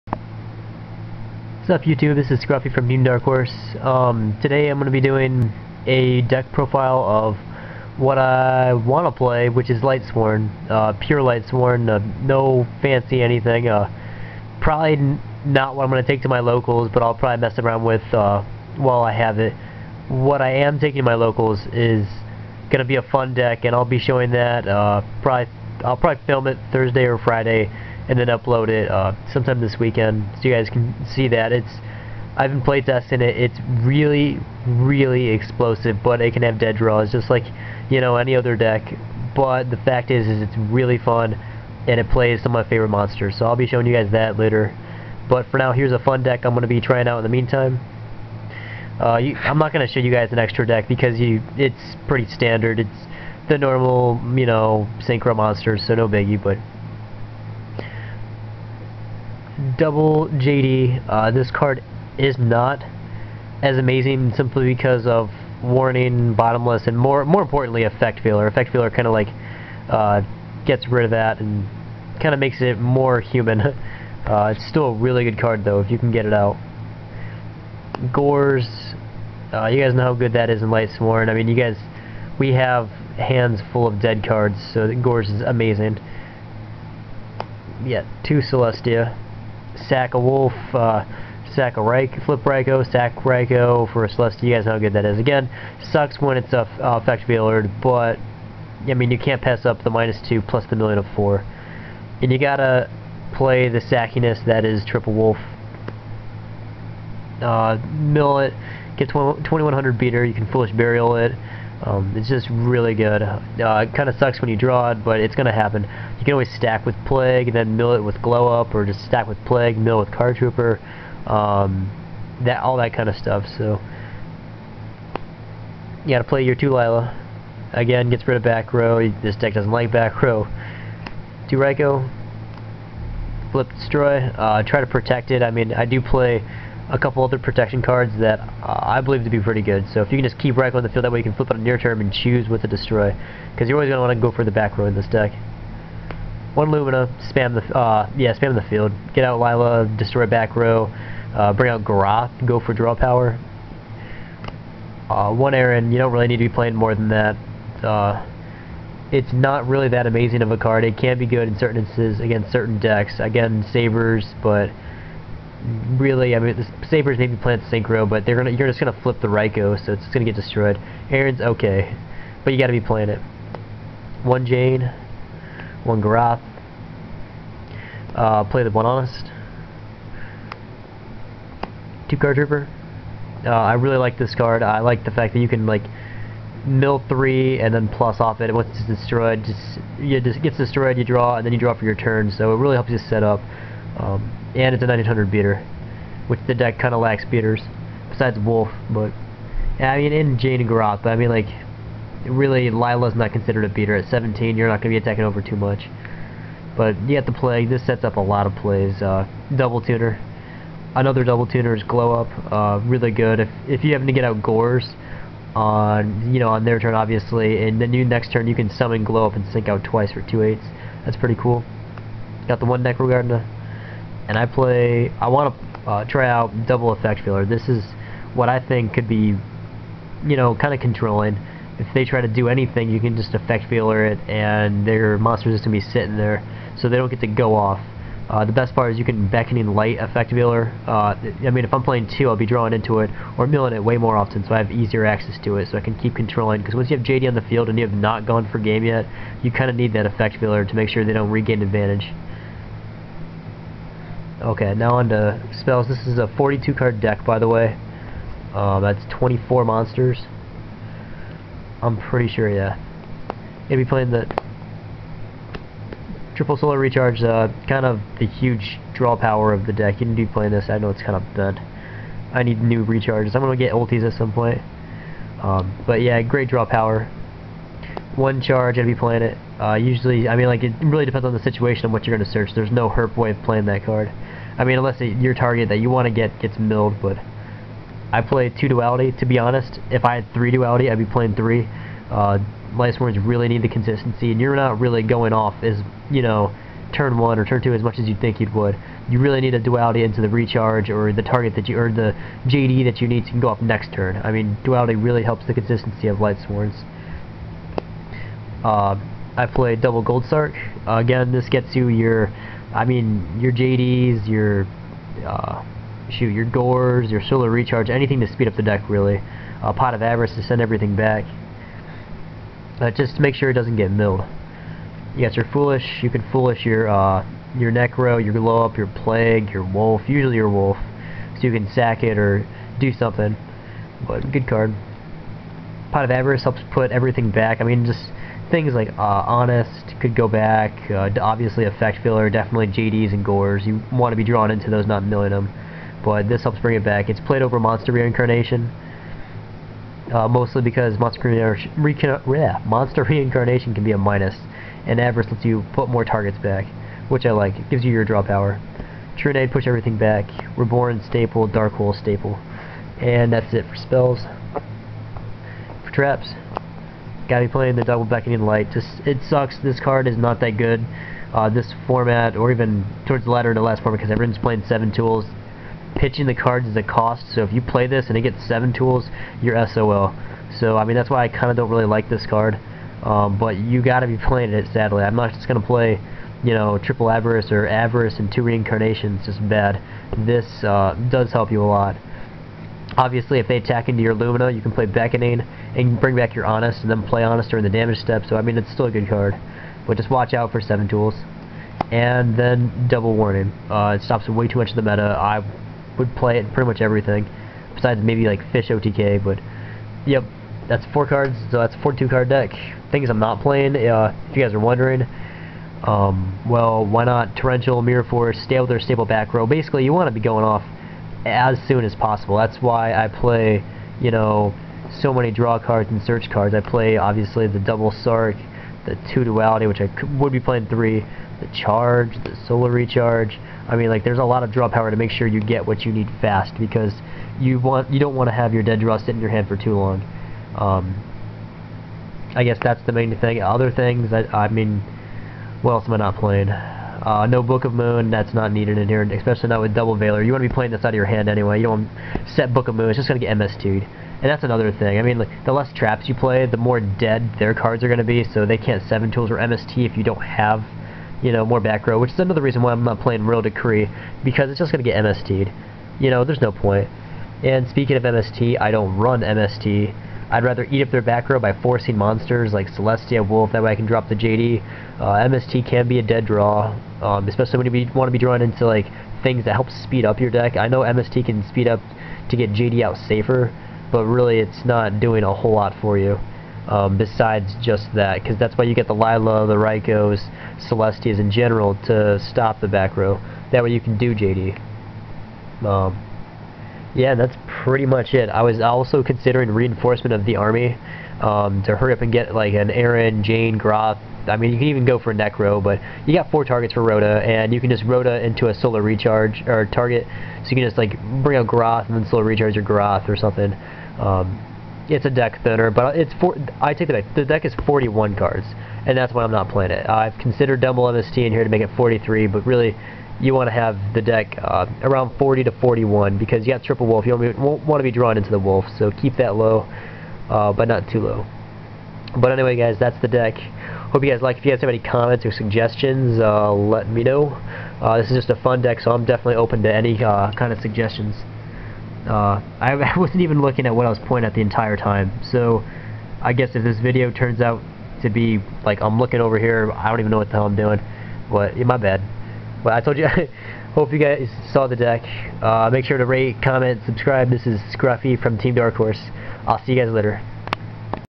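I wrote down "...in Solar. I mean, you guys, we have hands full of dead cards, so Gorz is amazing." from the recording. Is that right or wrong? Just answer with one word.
wrong.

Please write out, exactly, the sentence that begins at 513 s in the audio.
Um, it's a deck thinner, but it's four, I take the deck.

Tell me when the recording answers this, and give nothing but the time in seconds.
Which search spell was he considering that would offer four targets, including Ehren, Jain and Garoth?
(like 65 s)
499 s.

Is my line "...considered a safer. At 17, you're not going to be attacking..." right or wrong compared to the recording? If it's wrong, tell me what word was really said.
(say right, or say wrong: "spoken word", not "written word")
wrong: "beater", not "safer".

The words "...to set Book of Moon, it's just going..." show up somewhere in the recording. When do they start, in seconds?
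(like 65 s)
452 s.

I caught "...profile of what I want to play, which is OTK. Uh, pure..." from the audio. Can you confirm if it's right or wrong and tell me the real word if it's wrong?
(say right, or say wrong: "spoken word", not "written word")
wrong: "Lightsworn", not "OTK".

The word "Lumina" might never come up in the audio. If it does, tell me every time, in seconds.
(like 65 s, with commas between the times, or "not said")
146 s, 394 s.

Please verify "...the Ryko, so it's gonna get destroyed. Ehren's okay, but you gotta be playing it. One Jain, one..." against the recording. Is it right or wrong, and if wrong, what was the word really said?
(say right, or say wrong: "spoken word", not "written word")
right.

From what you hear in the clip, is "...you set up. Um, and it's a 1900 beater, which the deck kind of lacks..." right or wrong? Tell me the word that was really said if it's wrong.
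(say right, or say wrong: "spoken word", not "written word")
right.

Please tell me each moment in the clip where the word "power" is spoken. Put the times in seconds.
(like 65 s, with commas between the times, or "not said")
152 s, 269 s, 276 s, 358 s, 434 s.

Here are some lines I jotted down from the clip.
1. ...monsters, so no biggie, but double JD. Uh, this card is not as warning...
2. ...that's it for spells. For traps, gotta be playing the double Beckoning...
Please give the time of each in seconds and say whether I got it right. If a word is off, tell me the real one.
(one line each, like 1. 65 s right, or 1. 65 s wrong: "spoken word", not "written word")
1. 55 s wrong: "amazing", not "warning"
2. 363 s right.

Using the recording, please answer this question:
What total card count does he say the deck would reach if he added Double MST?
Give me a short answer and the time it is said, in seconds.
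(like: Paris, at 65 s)
43, at 521 s.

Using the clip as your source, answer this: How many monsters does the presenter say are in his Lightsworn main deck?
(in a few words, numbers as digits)
24.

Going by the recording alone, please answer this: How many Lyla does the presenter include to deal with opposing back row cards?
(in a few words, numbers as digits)
2.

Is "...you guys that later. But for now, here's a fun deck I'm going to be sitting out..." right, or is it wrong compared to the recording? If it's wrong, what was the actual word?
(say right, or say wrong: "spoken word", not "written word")
wrong: "trying", not "sitting".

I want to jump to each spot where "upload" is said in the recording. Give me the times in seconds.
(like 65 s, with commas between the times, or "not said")
28 s.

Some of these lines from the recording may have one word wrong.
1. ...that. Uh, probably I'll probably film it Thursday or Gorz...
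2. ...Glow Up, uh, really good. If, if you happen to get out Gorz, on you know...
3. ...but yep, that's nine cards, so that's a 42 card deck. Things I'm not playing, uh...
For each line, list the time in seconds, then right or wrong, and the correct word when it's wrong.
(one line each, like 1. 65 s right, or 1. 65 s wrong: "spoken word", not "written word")
1. 24 s wrong: "Friday", not "Gorz"
2. 211 s right
3. 409 s wrong: "four", not "nine".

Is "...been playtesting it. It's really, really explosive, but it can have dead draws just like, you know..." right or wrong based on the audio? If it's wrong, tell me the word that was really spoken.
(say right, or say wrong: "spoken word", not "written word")
right.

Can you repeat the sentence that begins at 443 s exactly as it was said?
Other things, I, I mean, what else am I not playing?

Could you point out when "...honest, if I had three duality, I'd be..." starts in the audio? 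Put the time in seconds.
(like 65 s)
289 s.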